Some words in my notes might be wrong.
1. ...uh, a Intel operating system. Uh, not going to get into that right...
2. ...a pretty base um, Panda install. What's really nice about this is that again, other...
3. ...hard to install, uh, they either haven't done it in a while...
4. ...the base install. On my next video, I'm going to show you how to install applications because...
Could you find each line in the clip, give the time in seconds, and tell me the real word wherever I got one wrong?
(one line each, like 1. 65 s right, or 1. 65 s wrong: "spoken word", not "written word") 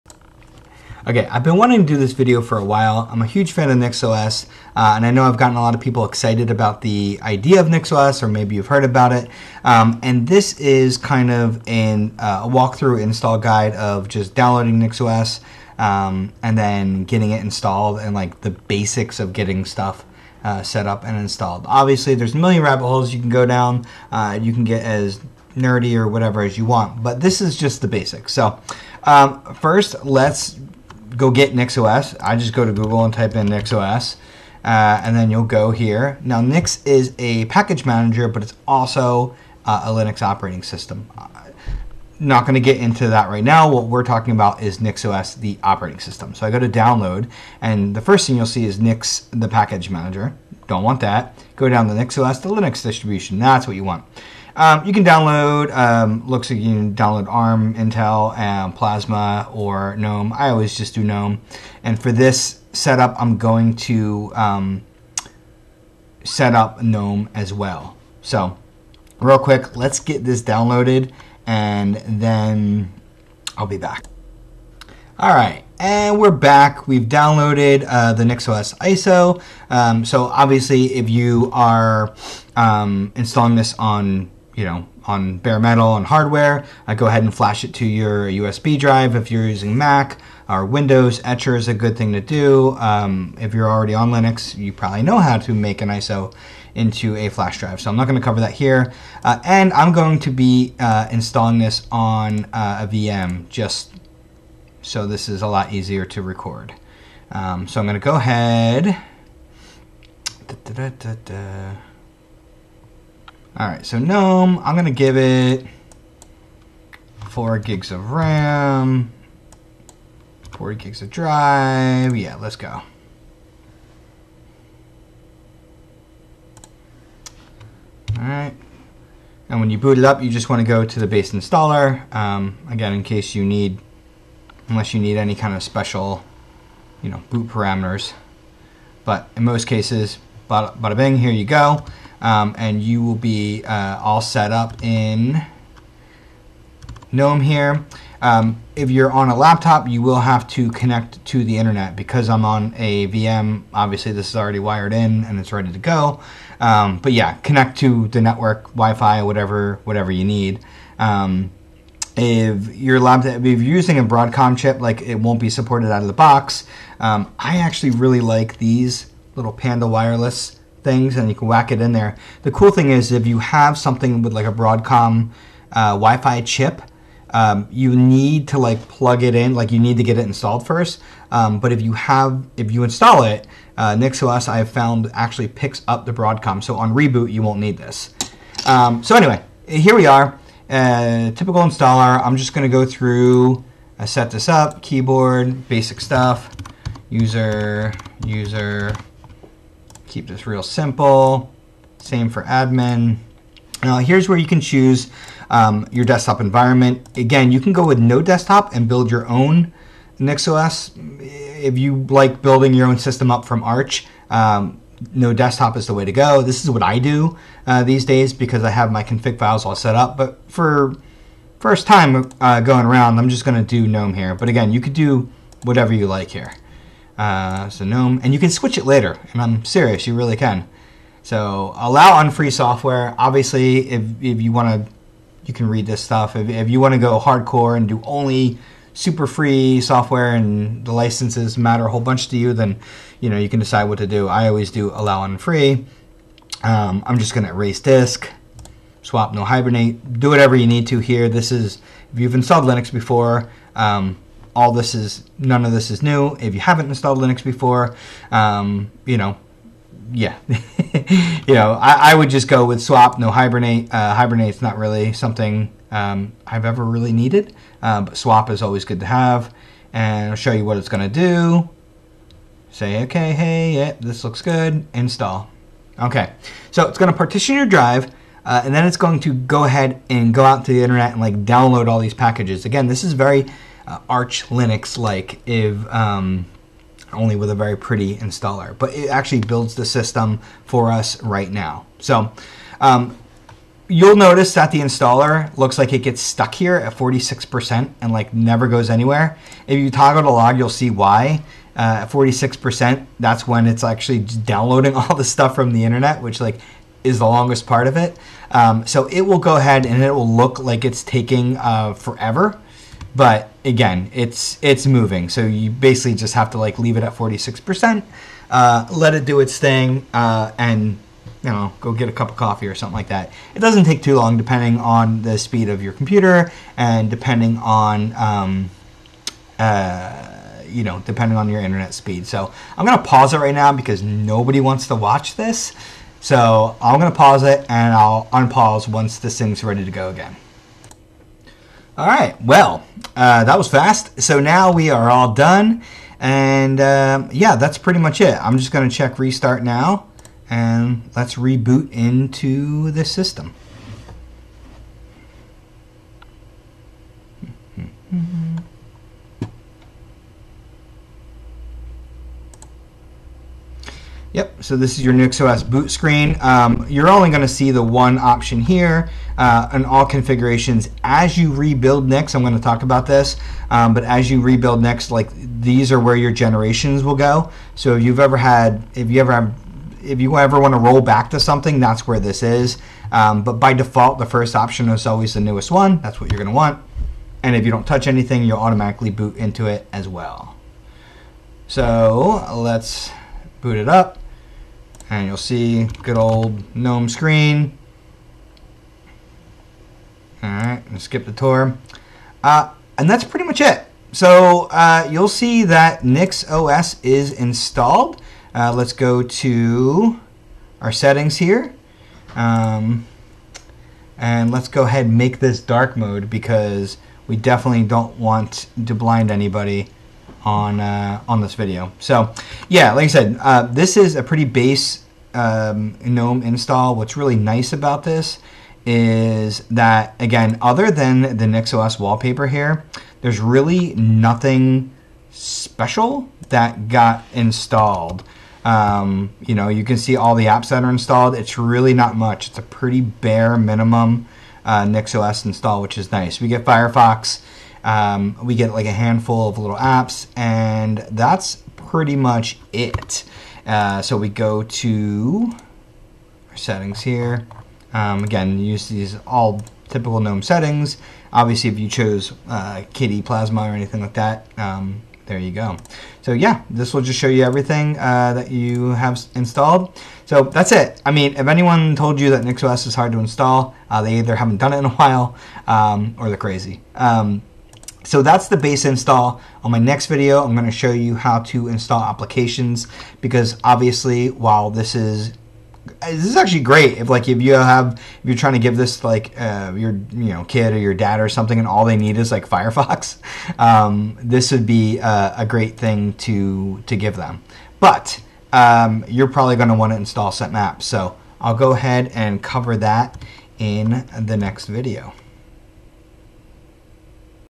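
1. 39 s wrong: "Linux", not "Intel"
2. 424 s wrong: "GNOME", not "Panda"
3. 472 s right
4. 478 s right.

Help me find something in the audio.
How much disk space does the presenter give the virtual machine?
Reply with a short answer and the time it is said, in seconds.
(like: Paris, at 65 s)
40 GB, at 120 s.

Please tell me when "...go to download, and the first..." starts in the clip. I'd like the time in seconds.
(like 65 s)
46 s.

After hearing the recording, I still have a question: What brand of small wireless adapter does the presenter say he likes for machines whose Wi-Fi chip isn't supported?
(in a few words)
Panda.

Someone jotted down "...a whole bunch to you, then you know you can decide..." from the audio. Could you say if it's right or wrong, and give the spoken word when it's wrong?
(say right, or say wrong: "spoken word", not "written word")
right.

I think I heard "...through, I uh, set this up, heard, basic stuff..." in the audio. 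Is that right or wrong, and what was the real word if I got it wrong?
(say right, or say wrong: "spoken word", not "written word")
wrong: "keyboard", not "heard".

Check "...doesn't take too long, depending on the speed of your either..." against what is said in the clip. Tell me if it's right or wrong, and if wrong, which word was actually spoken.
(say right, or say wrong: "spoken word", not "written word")
wrong: "computer", not "either".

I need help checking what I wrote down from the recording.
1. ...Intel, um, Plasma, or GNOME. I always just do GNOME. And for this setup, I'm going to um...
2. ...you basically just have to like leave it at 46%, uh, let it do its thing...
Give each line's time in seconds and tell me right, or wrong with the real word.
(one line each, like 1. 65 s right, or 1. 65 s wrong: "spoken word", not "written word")
1. 57 s right
2. 315 s right.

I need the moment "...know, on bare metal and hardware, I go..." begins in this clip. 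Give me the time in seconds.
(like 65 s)
84 s.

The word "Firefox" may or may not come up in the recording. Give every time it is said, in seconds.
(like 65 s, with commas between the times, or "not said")
446 s, 492 s.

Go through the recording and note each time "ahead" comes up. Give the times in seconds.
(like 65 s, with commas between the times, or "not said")
87 s, 108 s, 279 s, 309 s, 414 s, 501 s.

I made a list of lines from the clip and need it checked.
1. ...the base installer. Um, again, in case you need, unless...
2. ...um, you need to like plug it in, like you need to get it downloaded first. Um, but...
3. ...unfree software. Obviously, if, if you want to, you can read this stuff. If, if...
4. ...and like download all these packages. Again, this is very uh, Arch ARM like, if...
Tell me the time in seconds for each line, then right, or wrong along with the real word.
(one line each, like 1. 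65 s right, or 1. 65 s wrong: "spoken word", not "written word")
1. 130 s right
2. 177 s wrong: "installed", not "downloaded"
3. 232 s right
4. 281 s wrong: "Linux", not "ARM".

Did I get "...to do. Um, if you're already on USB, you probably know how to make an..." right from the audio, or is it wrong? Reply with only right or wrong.
wrong.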